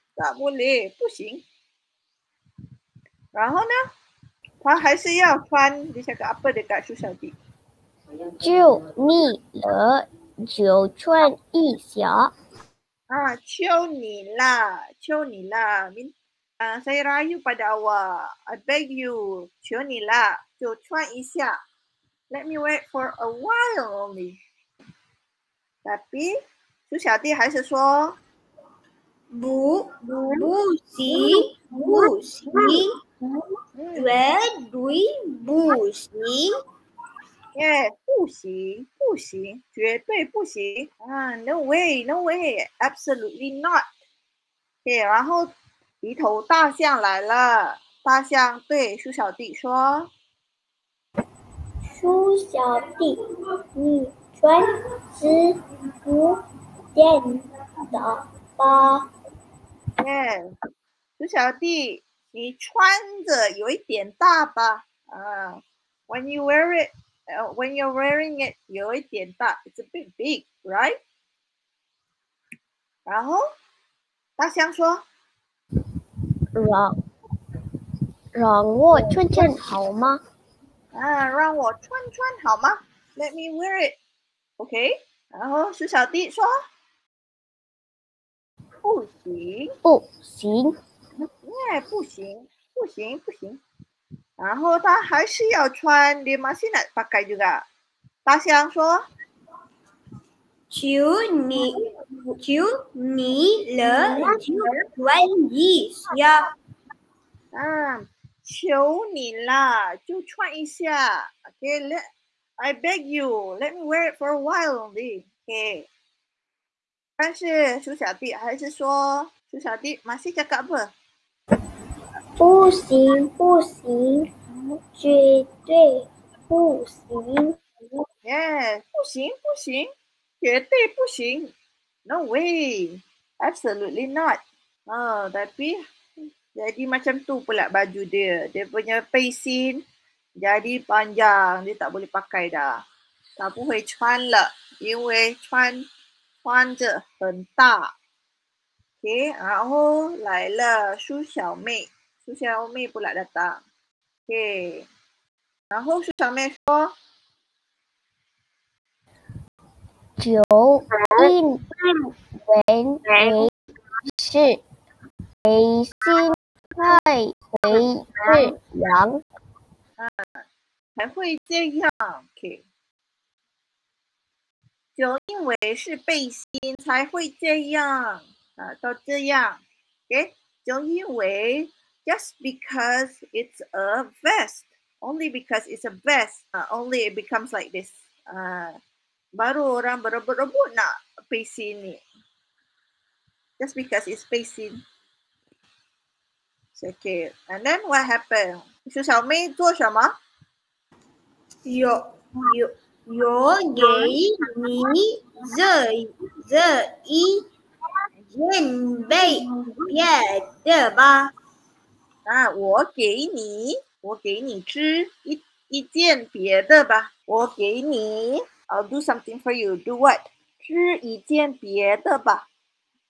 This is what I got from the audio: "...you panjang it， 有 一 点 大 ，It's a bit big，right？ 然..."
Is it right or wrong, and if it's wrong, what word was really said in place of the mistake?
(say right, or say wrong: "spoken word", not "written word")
wrong: "wearing", not "panjang".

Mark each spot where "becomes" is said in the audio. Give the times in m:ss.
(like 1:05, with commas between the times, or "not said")
3:07.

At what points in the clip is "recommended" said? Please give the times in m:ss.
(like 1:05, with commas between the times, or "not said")
not said.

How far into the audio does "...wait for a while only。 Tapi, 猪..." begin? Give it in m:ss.
0:22.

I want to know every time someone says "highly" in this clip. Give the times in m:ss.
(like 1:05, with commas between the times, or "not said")
not said.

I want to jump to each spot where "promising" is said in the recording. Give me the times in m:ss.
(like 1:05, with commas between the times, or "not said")
not said.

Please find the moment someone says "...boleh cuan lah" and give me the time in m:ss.
2:23.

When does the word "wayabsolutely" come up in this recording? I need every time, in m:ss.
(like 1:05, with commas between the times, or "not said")
0:42, 2:12.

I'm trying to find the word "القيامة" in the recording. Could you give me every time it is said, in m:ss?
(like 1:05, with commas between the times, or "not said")
not said.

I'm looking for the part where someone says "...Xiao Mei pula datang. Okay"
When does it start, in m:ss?
2:32.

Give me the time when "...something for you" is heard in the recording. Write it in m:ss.
3:39.